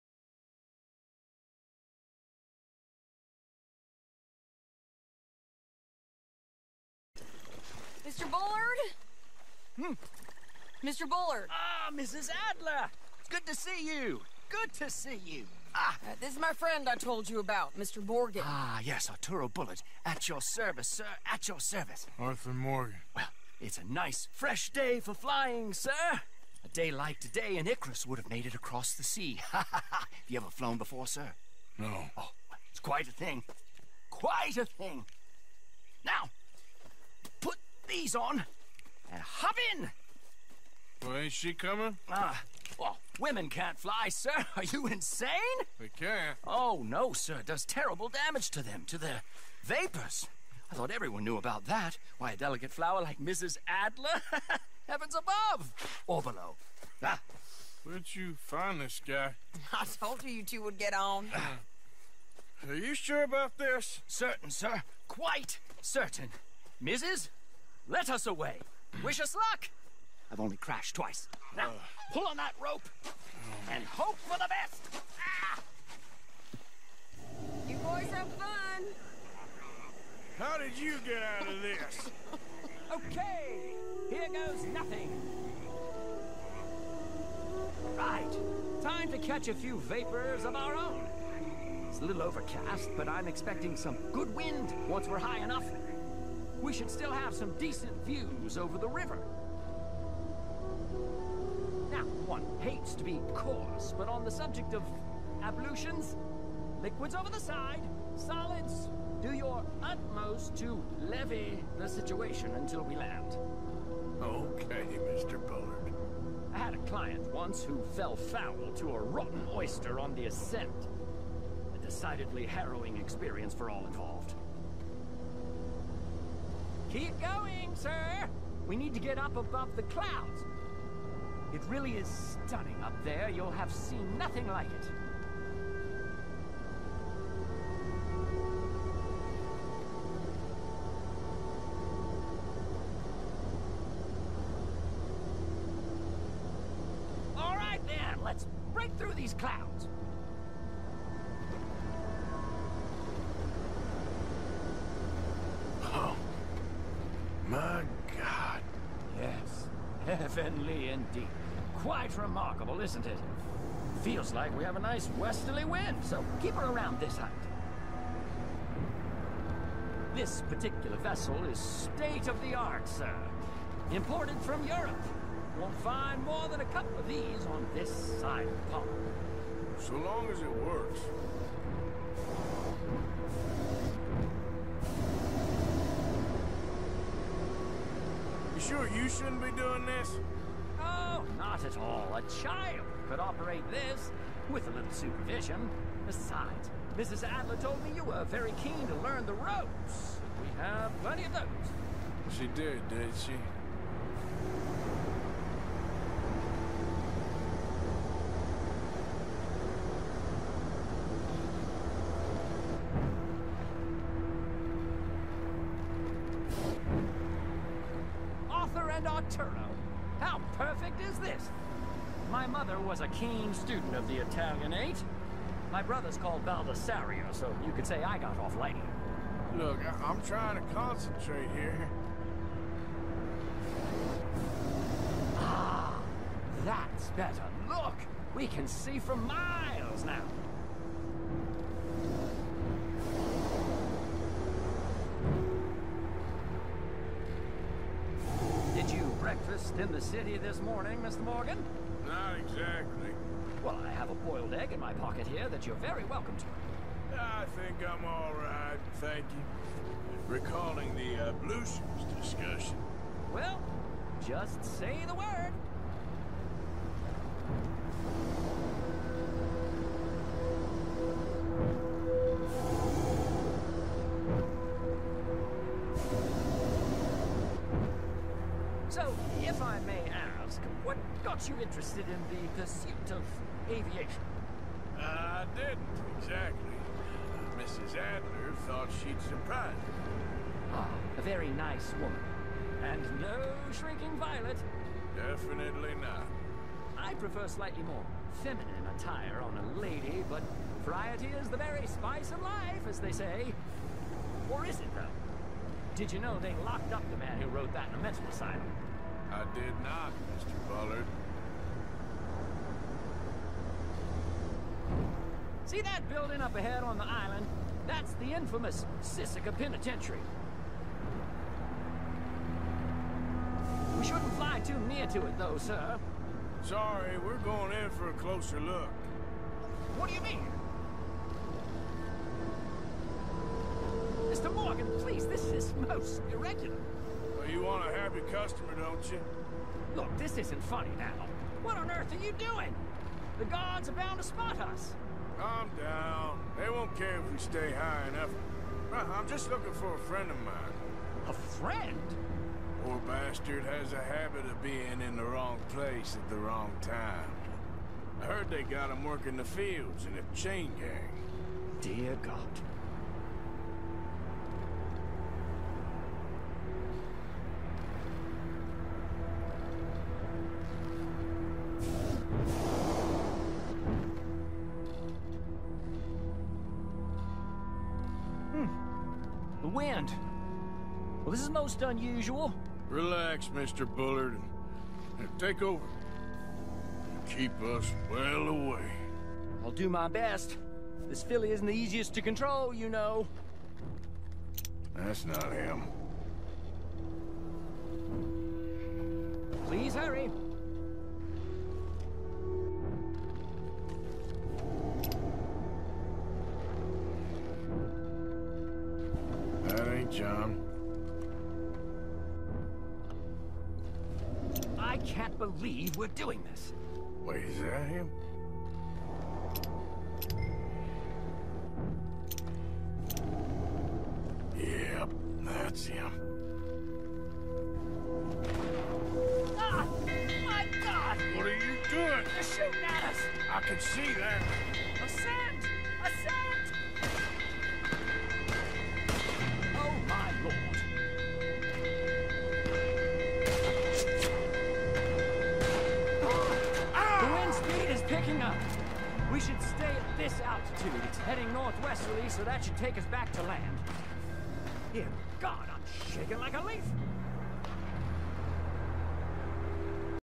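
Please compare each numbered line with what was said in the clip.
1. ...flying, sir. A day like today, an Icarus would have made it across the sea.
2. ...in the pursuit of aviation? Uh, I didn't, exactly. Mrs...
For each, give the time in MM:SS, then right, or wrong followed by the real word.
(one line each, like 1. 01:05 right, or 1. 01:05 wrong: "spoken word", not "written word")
1. 00:25 right
2. 04:42 right.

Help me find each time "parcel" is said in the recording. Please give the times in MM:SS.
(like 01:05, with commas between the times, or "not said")
not said.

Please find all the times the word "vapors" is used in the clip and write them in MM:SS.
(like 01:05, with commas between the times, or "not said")
00:49, 01:29.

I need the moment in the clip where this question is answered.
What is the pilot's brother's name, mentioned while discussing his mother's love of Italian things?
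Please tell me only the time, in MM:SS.
03:46.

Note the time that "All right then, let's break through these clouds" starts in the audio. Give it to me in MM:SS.
02:27.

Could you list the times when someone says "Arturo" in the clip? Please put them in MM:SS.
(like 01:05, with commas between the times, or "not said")
00:19, 03:39.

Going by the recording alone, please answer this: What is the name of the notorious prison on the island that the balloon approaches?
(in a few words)
Sisika Penitentiary.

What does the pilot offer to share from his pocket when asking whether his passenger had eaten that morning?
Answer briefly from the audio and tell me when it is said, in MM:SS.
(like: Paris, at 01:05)
a boiled egg, at 04:14.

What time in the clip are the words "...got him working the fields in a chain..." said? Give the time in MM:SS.
05:58.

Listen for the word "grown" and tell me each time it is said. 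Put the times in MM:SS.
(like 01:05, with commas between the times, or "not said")
not said.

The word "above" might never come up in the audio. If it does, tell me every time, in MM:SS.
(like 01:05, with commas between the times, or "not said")
00:55, 02:09.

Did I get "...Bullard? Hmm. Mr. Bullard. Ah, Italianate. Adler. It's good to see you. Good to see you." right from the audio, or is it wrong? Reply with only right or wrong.
wrong.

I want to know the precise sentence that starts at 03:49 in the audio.
Look, I am trying to concentrate here.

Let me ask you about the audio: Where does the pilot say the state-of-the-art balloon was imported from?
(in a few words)
Europe.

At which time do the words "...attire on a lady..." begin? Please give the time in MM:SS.
04:58.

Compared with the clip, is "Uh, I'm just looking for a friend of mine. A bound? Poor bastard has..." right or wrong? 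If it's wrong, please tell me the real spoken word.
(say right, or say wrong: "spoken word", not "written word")
wrong: "friend", not "bound".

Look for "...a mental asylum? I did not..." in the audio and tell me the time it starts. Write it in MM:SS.
05:07.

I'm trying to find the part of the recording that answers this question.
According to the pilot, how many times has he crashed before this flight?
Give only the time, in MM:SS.
01:10.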